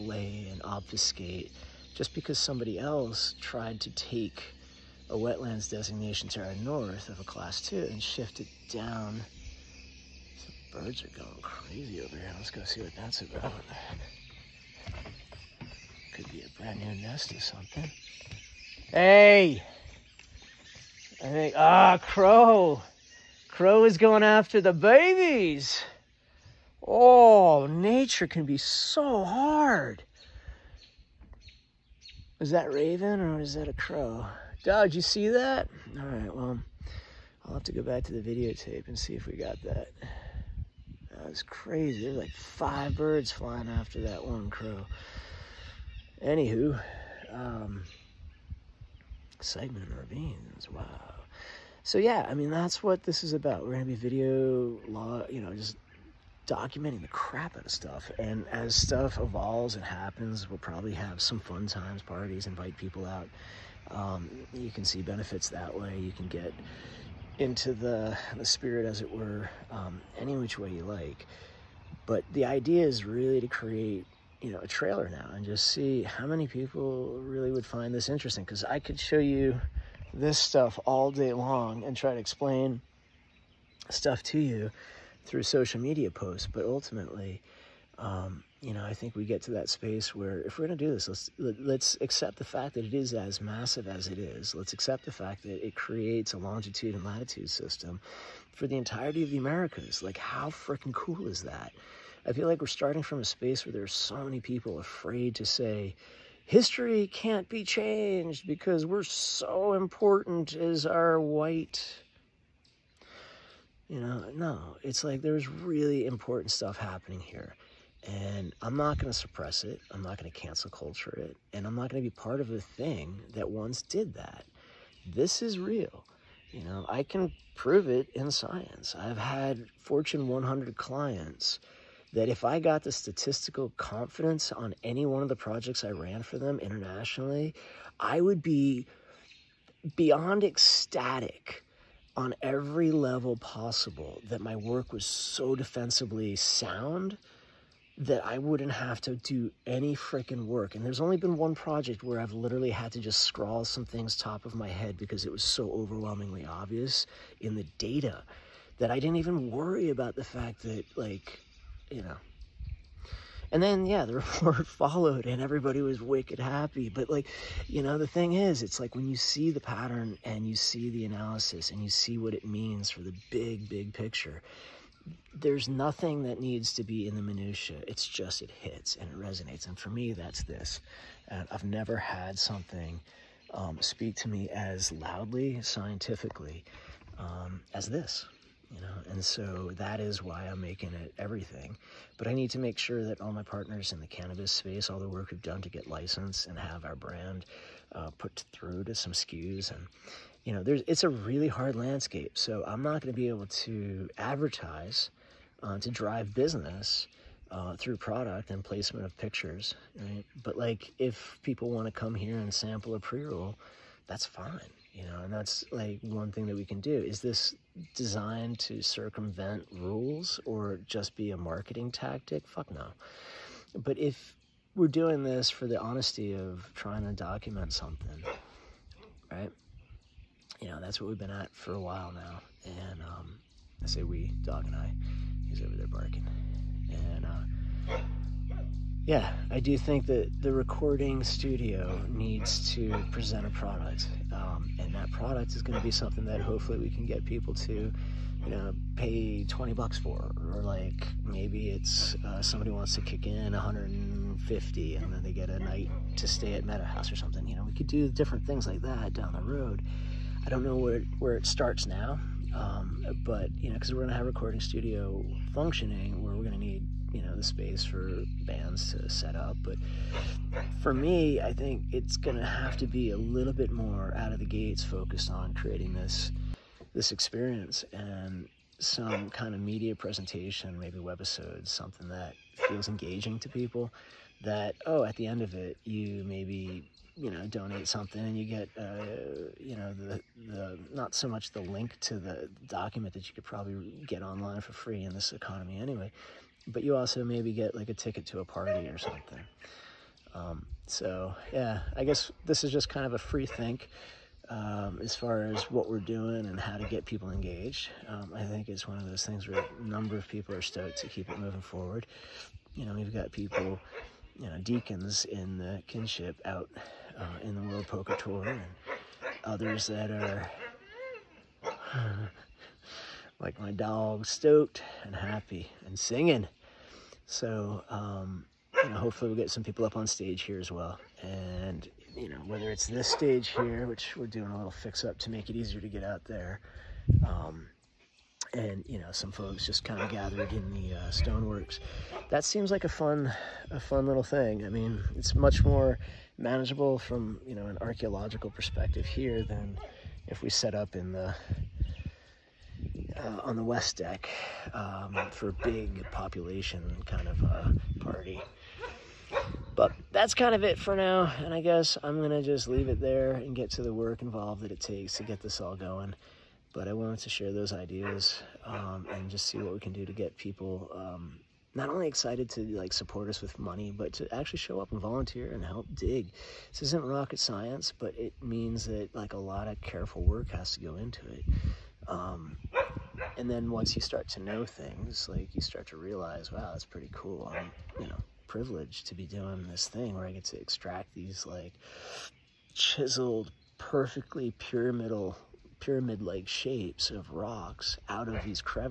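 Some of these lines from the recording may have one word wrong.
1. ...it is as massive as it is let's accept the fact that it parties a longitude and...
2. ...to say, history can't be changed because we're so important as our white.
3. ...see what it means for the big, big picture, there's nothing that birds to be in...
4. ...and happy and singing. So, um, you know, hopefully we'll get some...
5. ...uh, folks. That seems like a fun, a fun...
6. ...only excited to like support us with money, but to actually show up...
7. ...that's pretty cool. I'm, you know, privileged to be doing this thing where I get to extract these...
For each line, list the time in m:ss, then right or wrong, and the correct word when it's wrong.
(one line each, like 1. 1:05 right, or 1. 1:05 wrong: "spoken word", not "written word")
1. 1:32 wrong: "creates", not "parties"
2. 1:45 right
3. 2:51 wrong: "needs", not "birds"
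4. 5:25 right
5. 5:40 wrong: "stoneworks", not "folks"
6. 6:11 right
7. 6:26 right.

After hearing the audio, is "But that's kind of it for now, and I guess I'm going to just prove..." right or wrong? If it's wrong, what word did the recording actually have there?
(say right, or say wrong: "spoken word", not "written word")
wrong: "leave", not "prove".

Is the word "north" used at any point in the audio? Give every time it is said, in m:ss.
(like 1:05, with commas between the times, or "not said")
0:06.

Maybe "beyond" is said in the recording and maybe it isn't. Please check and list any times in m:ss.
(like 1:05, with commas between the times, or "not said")
2:19.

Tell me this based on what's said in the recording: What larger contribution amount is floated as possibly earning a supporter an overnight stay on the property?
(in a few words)
$150.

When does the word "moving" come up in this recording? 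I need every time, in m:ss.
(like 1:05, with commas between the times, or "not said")
5:11.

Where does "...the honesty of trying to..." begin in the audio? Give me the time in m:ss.
3:45.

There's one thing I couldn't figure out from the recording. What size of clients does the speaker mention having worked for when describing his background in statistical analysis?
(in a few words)
Fortune 100.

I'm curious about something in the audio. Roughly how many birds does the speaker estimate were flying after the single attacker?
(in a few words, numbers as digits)
5.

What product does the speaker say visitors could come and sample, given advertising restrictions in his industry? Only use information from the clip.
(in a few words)
A pre-roll.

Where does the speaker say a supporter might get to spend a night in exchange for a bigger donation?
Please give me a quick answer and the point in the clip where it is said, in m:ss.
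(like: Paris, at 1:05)
Meadow House, at 4:16.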